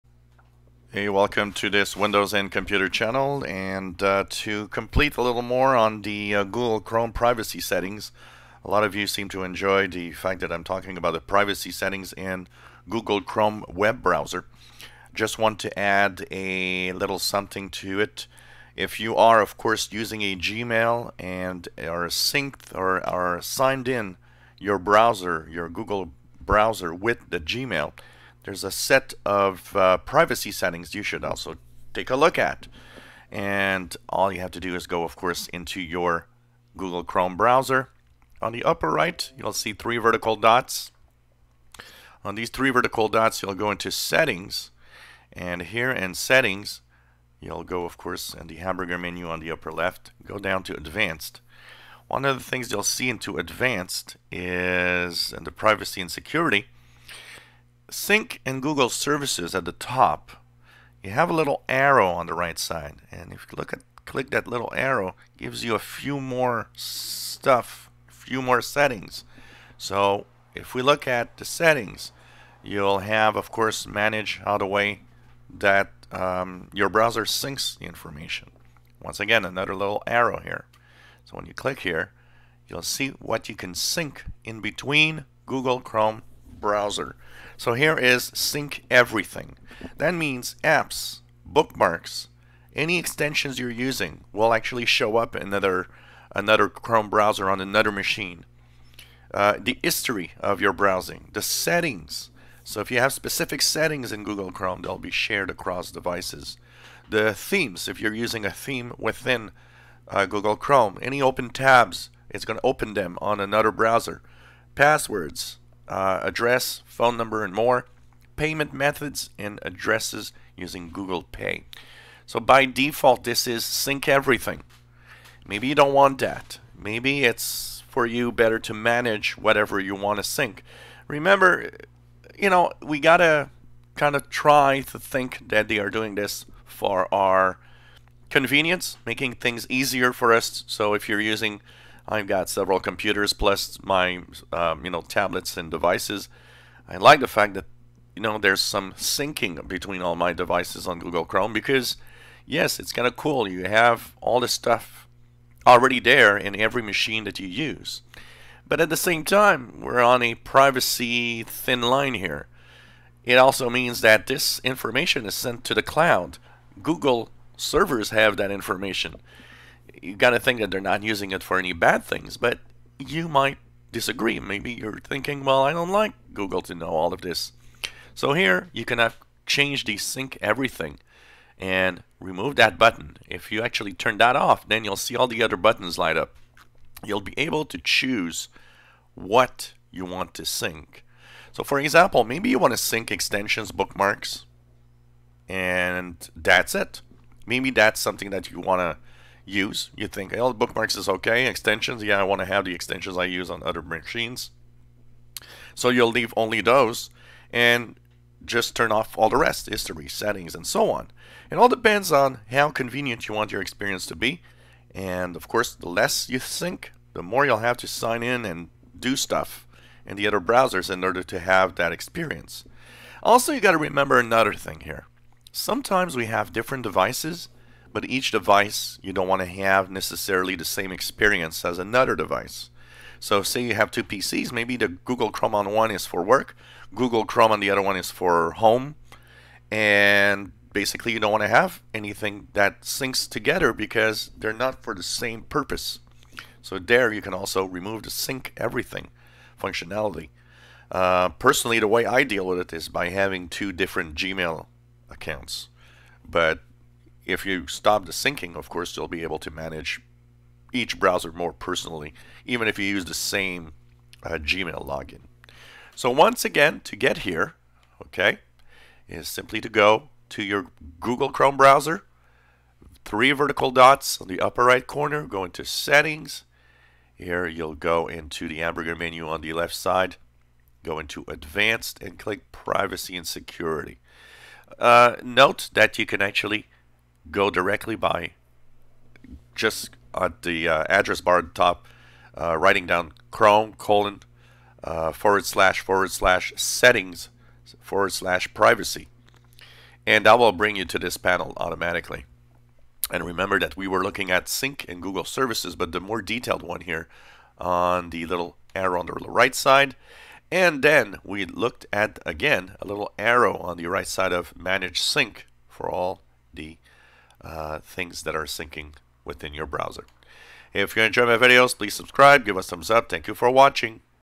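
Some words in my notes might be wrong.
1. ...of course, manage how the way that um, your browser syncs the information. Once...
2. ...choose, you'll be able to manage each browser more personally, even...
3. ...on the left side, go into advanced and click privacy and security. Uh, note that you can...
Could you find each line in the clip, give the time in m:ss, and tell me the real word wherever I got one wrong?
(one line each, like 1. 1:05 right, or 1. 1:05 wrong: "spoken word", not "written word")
1. 1:13 right
2. 4:18 wrong: "course", not "choose"
3. 4:39 right.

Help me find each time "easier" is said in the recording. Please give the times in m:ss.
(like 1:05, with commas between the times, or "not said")
2:19.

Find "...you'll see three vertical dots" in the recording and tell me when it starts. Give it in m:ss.
0:39.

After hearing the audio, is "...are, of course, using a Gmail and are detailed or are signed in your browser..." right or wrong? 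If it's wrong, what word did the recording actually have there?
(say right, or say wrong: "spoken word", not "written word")
wrong: "synced", not "detailed".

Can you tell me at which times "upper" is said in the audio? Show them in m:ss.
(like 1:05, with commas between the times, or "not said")
0:38, 0:49, 4:34.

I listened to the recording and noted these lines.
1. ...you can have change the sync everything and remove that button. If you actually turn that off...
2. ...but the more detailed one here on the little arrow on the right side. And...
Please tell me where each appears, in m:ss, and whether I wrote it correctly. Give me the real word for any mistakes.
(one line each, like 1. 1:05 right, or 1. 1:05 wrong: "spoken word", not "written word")
1. 2:58 right
2. 5:05 right.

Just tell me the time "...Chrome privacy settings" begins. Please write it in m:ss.
0:06.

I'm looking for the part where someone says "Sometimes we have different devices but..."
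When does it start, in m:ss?
3:45.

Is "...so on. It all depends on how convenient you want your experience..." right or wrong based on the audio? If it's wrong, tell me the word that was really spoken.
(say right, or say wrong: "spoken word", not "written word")
right.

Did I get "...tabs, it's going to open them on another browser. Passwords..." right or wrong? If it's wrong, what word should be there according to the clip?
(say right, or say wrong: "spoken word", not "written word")
right.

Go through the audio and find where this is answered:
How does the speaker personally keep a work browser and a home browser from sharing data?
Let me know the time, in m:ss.
4:13.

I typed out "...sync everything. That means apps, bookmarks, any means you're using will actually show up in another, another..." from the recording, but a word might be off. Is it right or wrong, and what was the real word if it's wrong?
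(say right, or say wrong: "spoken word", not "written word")
wrong: "extensions", not "means".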